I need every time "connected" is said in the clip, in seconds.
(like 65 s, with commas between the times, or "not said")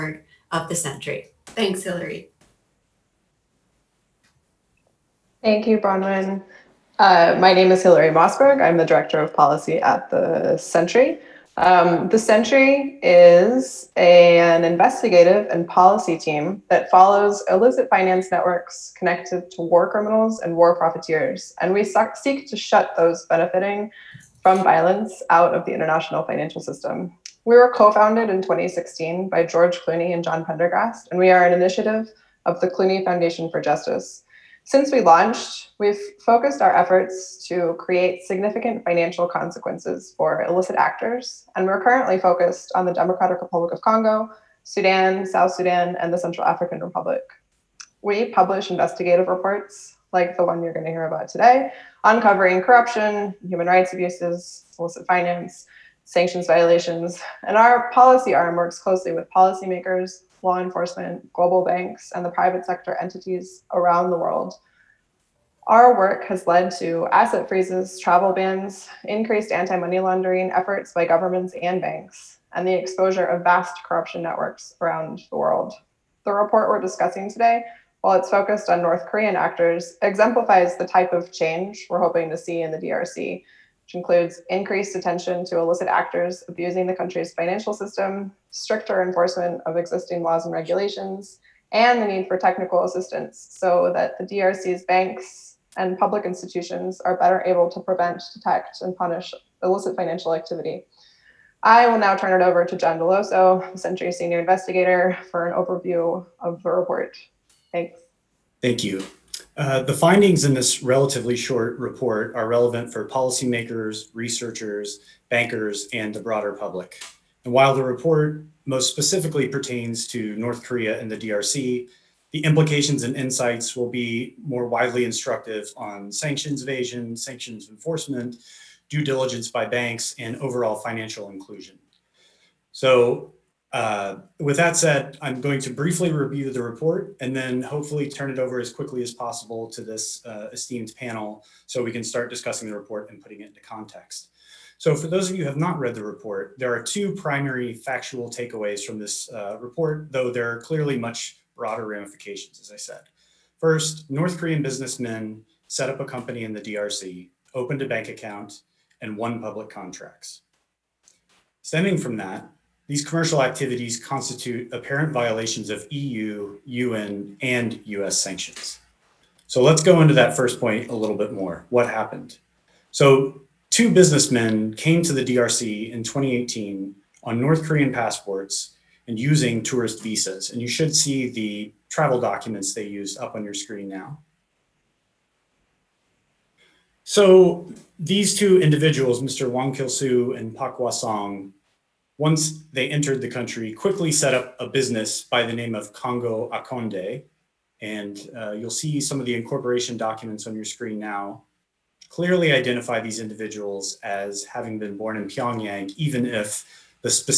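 18 s.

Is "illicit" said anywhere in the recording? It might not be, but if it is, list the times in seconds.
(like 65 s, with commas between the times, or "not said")
17 s, 40 s, 54 s, 85 s, 99 s.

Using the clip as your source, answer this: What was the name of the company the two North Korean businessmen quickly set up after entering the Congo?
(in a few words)
Congo Akonde.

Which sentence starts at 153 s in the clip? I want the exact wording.
First, North Korean businessmen set up a company in the DRC, opened a bank account, and won public contracts.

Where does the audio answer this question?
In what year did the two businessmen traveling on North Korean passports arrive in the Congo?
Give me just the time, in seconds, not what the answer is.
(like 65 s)
176 s.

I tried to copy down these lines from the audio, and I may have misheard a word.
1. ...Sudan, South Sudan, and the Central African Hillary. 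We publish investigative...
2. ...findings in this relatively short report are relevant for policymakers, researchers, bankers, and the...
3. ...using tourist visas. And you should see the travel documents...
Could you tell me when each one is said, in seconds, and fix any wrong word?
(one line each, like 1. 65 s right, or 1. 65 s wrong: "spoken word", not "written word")
1. 44 s wrong: "Republic", not "Hillary"
2. 109 s right
3. 179 s right.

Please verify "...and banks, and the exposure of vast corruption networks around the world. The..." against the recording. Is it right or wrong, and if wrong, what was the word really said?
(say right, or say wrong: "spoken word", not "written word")
right.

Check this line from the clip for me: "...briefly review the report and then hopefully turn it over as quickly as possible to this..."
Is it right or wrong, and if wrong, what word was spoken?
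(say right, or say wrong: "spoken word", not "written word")
right.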